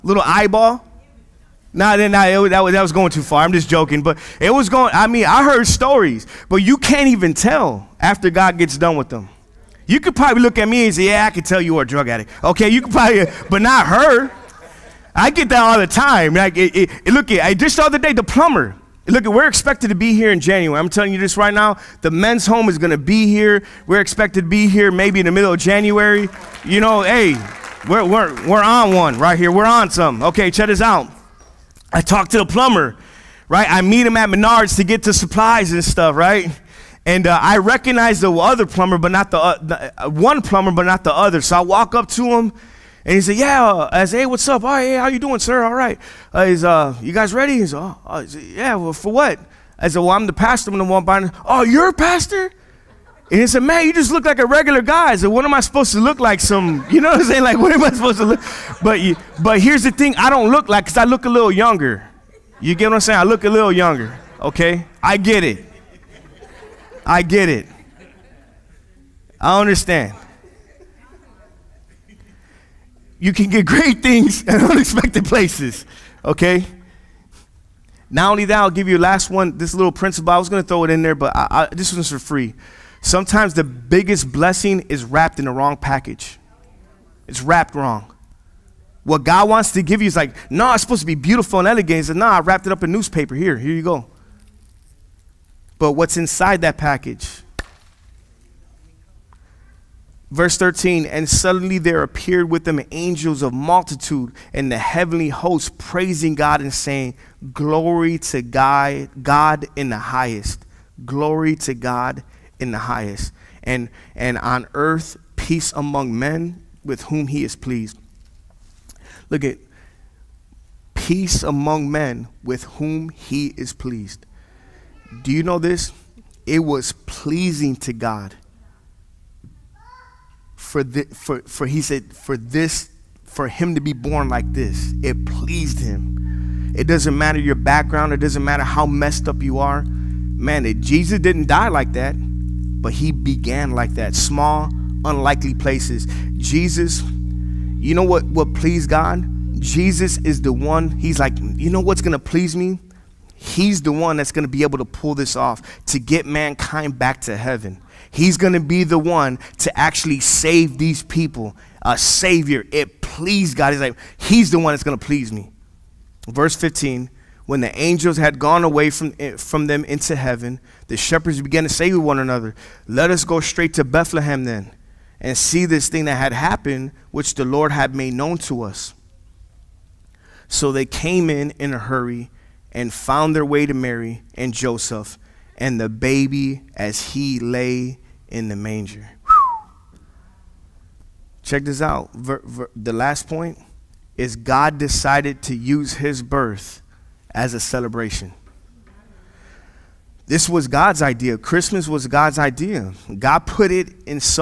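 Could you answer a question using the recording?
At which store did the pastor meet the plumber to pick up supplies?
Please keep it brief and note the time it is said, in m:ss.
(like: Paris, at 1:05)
Menards, at 0:34.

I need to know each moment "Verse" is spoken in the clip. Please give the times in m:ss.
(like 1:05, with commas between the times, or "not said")
1:40, 2:46.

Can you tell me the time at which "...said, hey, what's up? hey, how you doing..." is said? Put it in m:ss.
0:44.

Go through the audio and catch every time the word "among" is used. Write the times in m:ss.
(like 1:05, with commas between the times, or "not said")
1:55, 2:01.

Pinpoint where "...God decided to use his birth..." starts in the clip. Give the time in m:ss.
3:14.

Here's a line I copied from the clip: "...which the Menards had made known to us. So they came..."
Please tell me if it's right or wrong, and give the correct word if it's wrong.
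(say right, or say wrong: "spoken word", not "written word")
wrong: "Lord", not "Menards".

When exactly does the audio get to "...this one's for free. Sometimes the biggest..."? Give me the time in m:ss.
1:21.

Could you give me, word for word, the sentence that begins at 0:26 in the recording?
You know, hey, we're, we're, we're on one right here.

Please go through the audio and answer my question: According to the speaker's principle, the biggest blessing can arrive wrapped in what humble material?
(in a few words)
Newspaper.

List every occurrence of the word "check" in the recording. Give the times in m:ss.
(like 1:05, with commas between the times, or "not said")
0:30, 3:11.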